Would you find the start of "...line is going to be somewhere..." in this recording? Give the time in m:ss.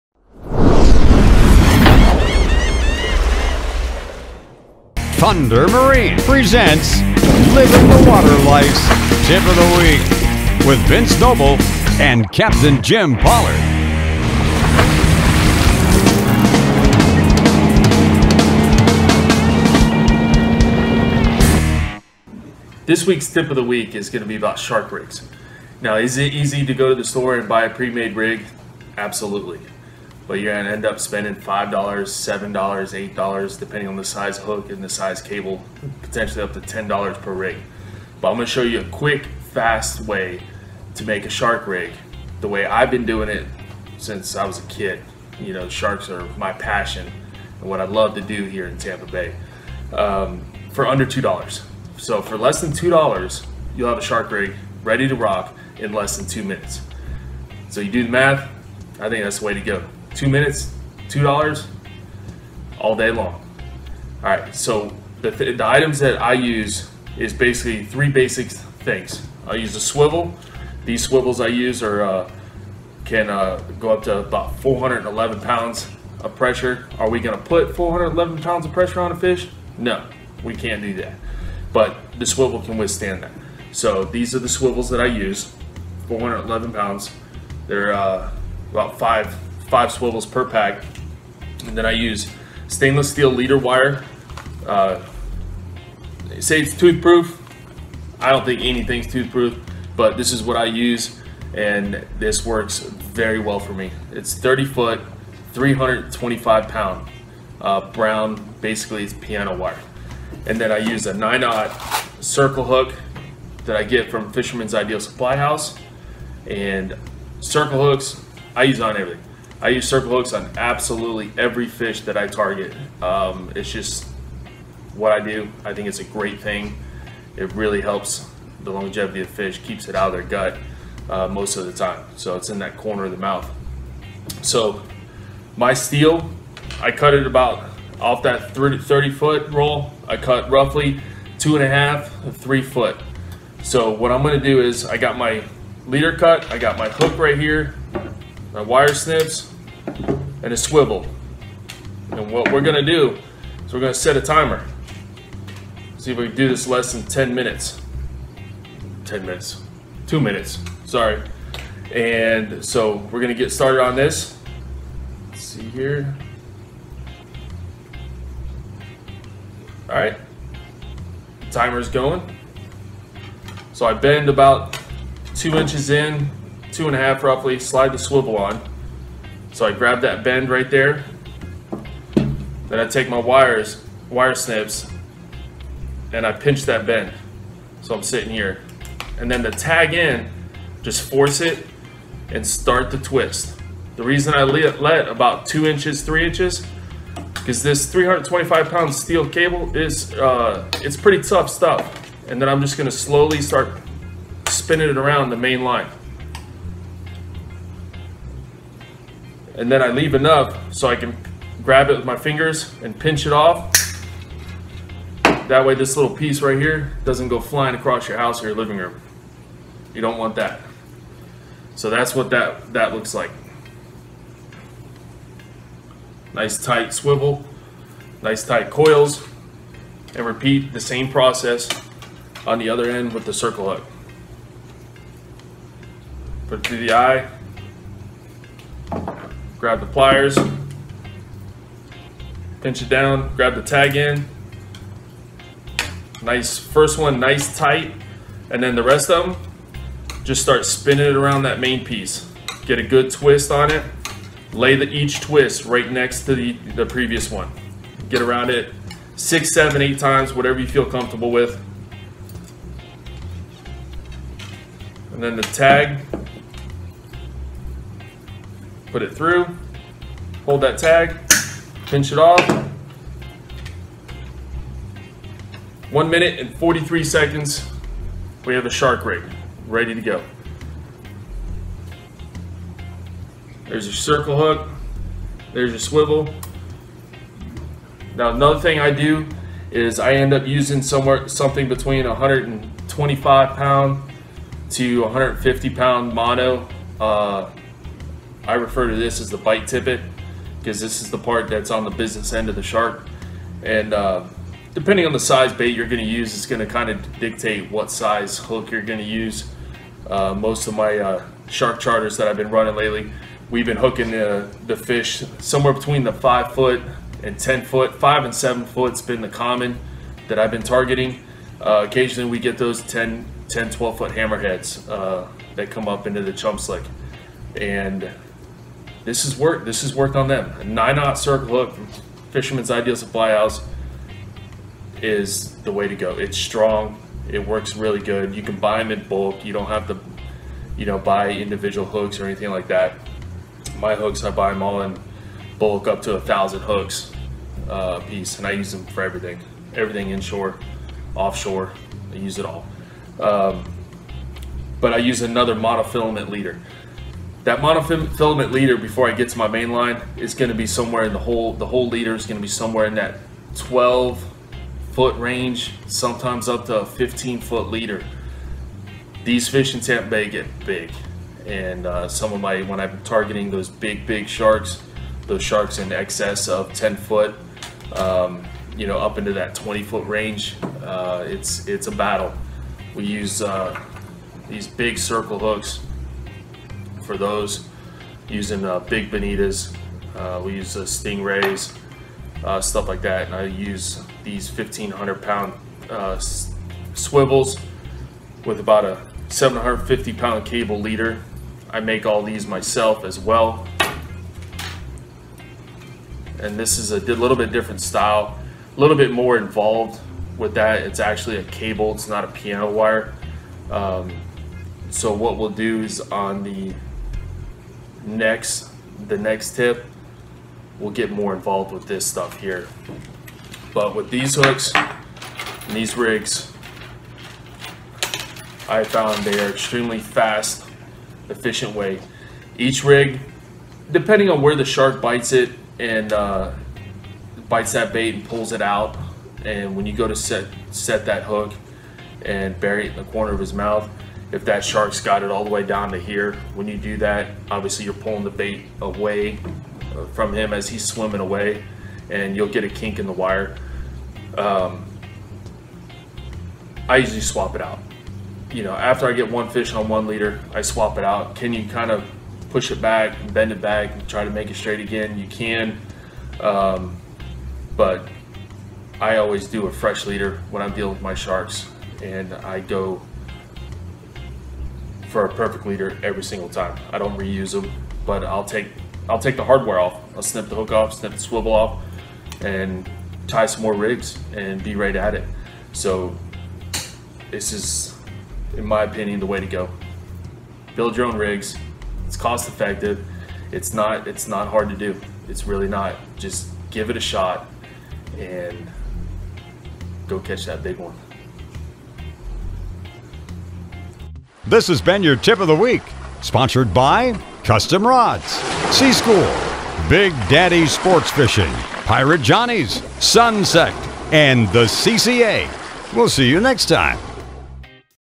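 5:59.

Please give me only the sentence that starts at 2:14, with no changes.
So my steel, I cut it about off that 30, foot roll.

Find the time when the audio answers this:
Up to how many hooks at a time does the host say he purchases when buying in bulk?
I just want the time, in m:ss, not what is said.
5:46.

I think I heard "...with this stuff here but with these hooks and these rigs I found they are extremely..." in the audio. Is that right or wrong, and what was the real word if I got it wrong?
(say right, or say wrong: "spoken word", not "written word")
right.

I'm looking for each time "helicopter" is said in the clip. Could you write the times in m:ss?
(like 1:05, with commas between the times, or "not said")
not said.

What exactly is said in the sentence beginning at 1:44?
It's 30 foot, 325 pound uh, brown, basically it's piano wire.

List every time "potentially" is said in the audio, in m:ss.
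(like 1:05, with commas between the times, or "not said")
0:36.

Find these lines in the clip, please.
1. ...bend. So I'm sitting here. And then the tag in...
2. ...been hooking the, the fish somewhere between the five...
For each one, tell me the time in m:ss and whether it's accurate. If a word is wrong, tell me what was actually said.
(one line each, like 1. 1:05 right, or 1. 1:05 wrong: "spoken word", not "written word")
1. 3:06 right
2. 5:13 right.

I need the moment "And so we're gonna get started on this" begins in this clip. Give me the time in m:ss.
2:41.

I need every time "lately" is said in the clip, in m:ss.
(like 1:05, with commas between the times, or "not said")
5:12.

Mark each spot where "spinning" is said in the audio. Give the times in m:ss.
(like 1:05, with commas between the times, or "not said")
3:24, 4:10.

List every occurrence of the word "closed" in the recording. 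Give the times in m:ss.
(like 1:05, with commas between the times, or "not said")
not said.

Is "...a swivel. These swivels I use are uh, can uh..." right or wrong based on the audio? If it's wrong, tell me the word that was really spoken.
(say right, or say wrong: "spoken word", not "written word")
right.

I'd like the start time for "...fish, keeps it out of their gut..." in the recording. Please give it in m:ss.
2:09.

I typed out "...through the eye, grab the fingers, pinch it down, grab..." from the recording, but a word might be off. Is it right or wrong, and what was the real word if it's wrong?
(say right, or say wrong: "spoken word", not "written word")
wrong: "pliers", not "fingers".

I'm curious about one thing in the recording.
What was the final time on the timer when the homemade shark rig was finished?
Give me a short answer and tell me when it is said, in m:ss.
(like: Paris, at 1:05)
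1 minute 43 seconds, at 4:35.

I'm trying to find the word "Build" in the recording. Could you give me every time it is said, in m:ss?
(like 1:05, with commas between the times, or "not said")
8:10.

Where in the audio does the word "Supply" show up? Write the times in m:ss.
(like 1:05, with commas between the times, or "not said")
1:54, 5:32.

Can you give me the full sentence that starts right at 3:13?
The reason I let about two inches, three inches, because this 325 pound steel cable is, uh, it's pretty tough stuff.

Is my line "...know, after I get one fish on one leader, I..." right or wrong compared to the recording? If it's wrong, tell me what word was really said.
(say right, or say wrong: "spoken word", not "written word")
right.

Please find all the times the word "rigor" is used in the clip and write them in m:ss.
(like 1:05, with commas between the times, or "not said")
not said.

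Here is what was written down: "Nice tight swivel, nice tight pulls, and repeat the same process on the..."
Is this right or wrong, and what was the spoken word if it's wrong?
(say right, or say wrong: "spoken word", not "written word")
wrong: "coils", not "pulls".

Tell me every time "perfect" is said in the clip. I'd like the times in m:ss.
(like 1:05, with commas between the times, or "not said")
7:55.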